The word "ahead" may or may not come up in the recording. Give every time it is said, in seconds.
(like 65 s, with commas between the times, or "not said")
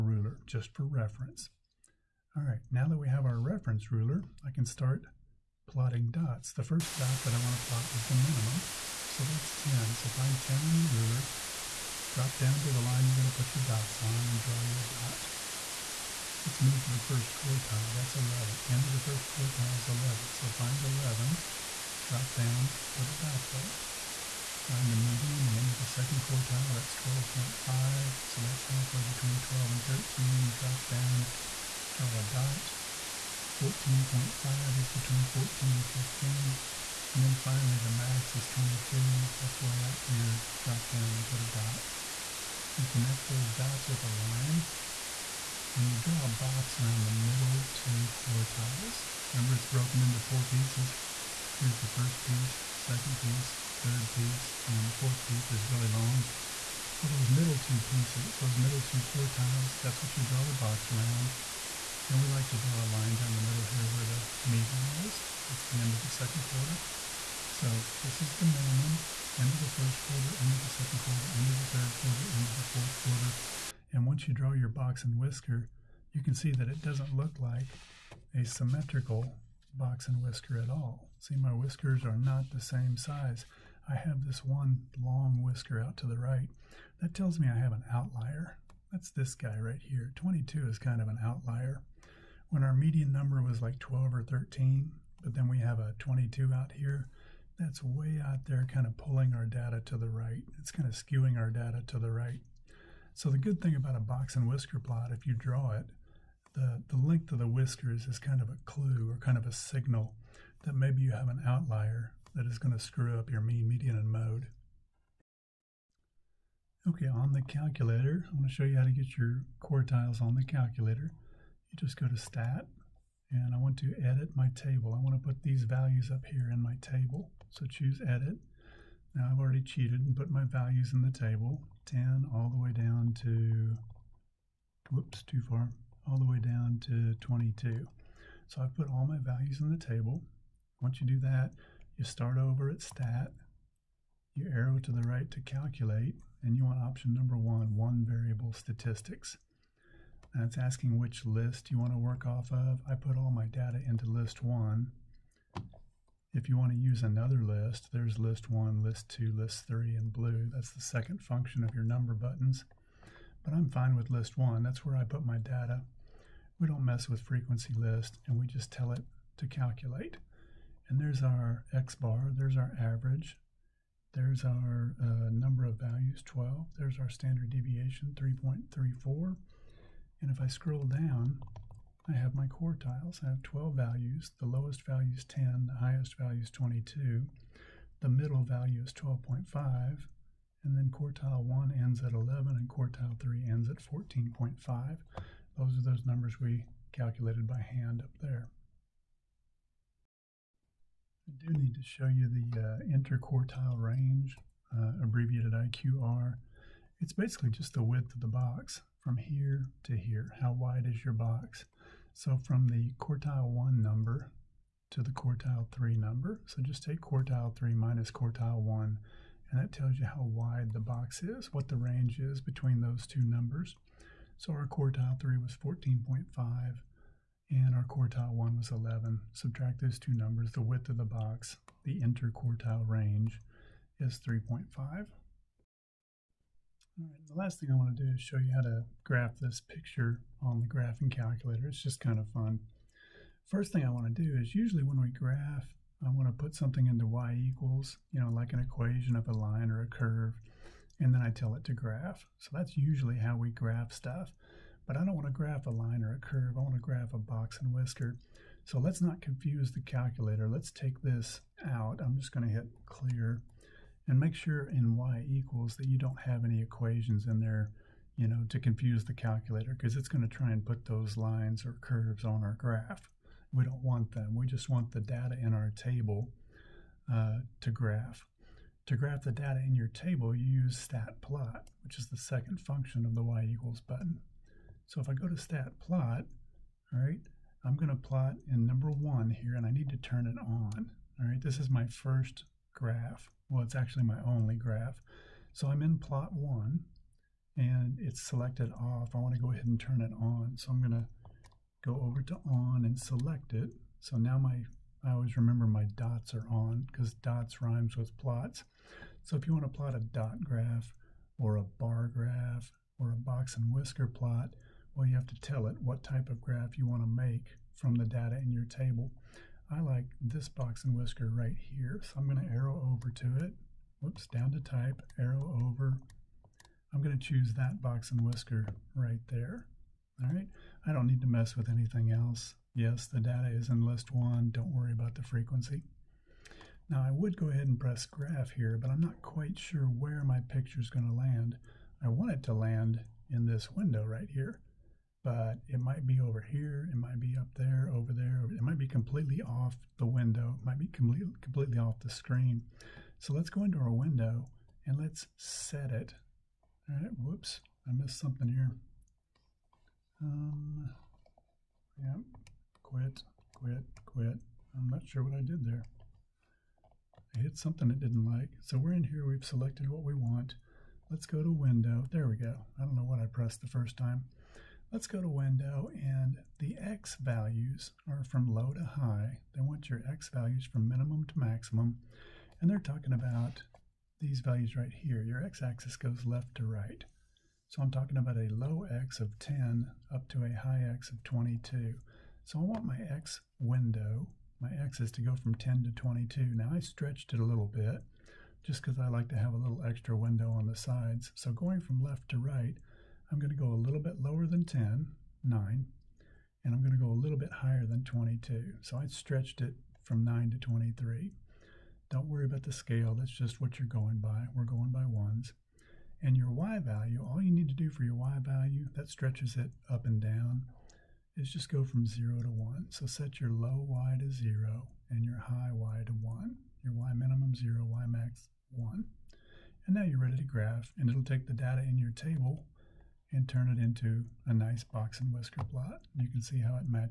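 299 s, 337 s.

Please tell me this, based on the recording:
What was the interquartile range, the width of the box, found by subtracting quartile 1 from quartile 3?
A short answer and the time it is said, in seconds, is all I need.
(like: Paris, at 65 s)
3.5, at 232 s.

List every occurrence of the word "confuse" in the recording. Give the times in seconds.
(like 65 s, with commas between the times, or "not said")
259 s, 268 s.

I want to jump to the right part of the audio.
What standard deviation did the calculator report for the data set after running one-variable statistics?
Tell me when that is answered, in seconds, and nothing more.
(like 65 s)
178 s.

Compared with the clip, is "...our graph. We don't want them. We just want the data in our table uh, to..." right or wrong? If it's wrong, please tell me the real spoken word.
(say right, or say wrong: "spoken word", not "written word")
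right.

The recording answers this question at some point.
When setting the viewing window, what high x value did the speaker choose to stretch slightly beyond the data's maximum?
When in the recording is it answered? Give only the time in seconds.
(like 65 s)
410 s.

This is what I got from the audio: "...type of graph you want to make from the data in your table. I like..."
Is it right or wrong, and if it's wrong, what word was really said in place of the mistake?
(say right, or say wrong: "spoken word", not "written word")
right.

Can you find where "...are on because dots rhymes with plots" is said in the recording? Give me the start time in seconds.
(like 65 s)
306 s.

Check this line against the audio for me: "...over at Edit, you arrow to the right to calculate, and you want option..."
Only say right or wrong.
wrong.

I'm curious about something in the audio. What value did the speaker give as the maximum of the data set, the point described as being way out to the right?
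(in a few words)
22.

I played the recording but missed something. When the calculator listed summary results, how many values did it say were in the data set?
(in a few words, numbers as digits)
12.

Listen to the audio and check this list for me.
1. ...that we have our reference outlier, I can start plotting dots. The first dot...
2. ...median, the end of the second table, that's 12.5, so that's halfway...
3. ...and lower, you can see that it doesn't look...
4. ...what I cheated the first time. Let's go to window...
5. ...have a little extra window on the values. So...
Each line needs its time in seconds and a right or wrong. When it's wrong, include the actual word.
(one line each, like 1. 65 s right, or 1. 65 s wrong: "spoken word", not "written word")
1. 2 s wrong: "ruler", not "outlier"
2. 24 s wrong: "quartile", not "table"
3. 75 s wrong: "whisker", not "lower"
4. 373 s wrong: "pressed", not "cheated"
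5. 399 s wrong: "sides", not "values".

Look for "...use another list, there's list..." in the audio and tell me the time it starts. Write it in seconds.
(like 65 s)
156 s.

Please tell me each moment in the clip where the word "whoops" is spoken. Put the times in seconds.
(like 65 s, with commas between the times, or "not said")
134 s, 324 s, 357 s.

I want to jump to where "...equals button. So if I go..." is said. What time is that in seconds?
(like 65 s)
283 s.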